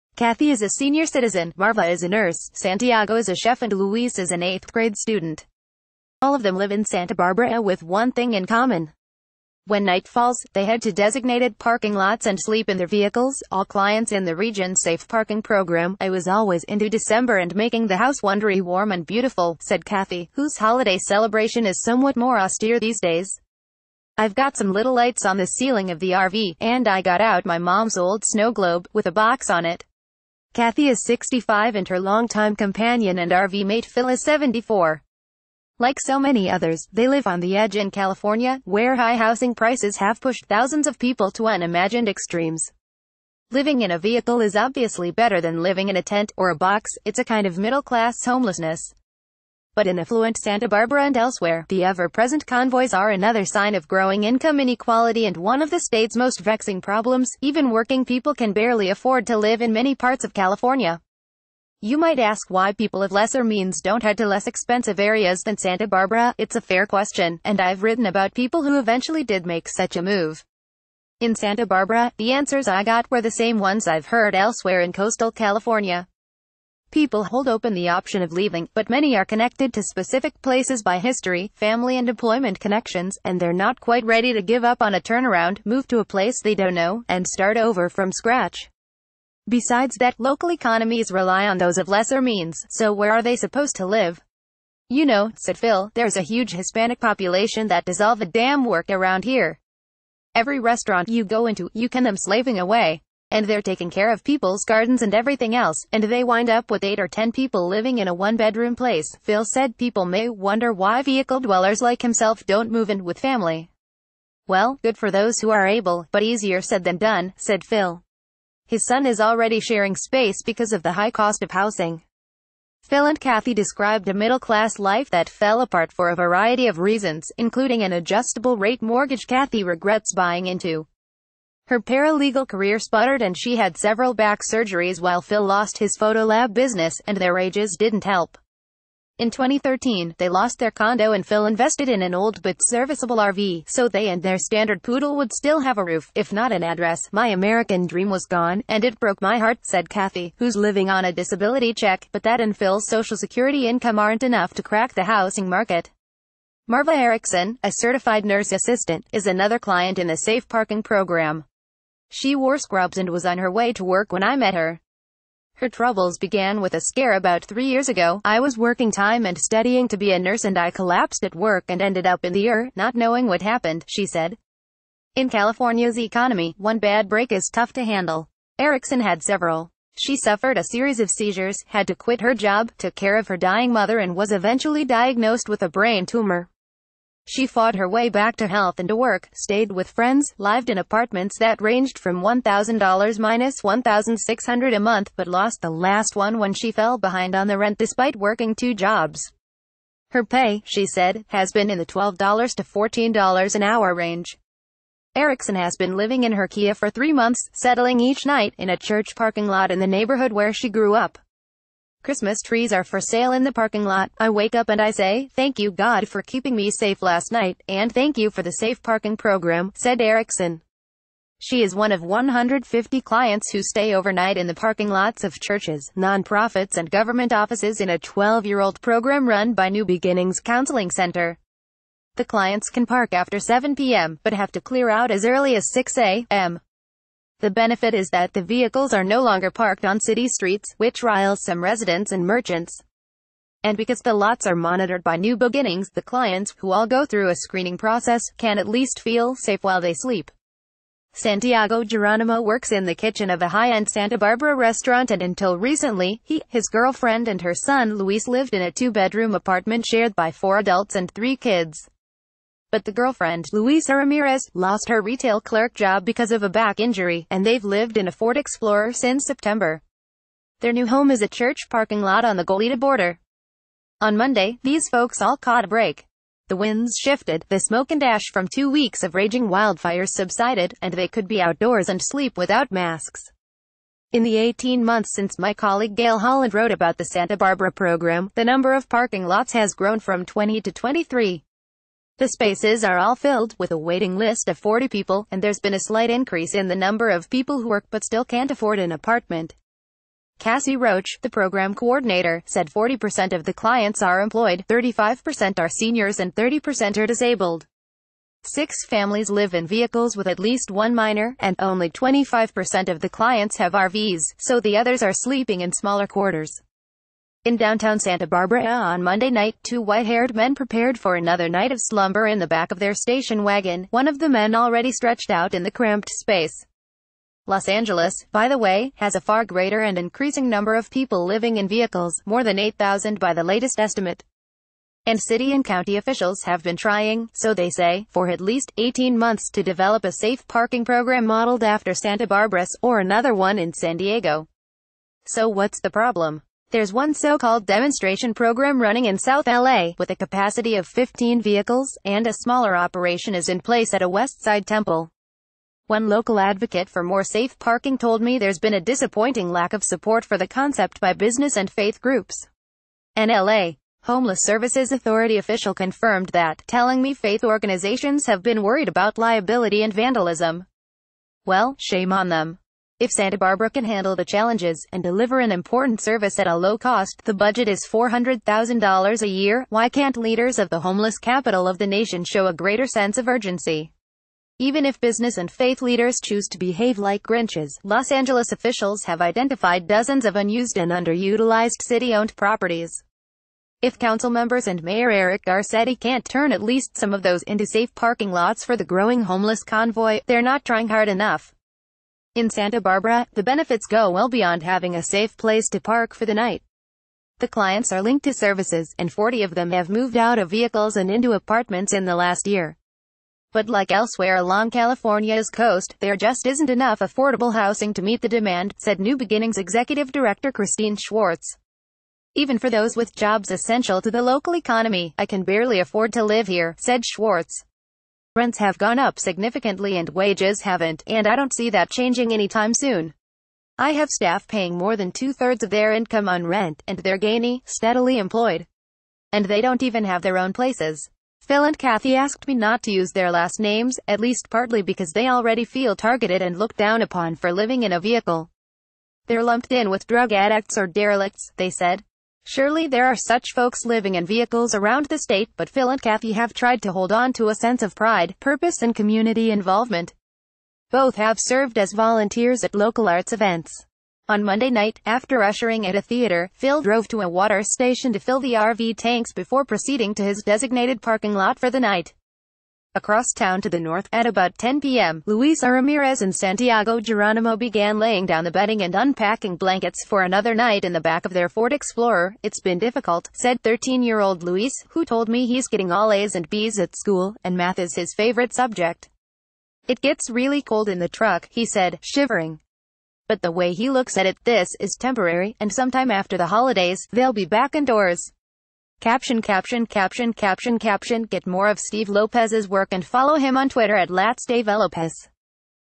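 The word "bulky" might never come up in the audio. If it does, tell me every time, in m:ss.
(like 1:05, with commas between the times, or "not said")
not said.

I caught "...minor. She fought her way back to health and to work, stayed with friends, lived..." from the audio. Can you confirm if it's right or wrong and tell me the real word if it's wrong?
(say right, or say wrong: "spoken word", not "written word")
wrong: "tumor", not "minor".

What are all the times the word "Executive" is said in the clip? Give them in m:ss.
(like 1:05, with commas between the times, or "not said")
6:59.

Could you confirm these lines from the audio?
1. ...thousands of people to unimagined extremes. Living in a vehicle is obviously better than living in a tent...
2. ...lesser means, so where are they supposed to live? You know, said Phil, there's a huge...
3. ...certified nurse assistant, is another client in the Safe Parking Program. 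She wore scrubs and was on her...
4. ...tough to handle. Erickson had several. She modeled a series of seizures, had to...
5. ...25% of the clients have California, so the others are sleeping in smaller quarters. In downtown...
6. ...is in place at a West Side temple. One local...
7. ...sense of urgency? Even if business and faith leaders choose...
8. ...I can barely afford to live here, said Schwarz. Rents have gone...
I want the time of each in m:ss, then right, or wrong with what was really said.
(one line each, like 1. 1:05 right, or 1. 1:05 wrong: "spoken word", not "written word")
1. 0:40 right
2. 1:31 right
3. 2:37 right
4. 2:57 wrong: "suffered", not "modeled"
5. 5:11 wrong: "RVs", not "California"
6. 5:53 right
7. 6:22 right
8. 7:05 right.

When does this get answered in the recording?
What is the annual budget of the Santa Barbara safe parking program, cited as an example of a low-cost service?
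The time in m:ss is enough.
6:17.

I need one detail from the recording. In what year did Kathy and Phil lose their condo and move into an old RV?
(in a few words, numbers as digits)
2013.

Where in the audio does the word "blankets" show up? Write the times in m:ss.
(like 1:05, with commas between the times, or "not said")
7:59.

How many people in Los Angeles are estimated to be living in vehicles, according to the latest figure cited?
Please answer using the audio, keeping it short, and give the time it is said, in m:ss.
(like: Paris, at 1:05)
More than 8,000, at 5:32.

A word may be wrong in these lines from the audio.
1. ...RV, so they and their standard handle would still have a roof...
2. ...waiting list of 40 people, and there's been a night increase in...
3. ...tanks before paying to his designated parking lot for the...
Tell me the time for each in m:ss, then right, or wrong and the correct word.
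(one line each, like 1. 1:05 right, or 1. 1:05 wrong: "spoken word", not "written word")
1. 2:23 wrong: "poodle", not "handle"
2. 4:53 wrong: "slight", not "night"
3. 7:48 wrong: "proceeding", not "paying".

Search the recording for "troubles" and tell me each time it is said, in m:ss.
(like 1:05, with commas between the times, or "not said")
2:45.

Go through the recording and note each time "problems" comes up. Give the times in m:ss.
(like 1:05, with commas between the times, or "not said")
0:56, 5:45.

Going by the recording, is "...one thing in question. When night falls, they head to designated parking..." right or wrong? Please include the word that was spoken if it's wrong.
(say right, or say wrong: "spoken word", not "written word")
wrong: "common", not "question".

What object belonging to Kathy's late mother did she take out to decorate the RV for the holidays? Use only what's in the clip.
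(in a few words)
Snow globe.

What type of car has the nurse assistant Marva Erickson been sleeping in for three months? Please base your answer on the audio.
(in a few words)
Kia.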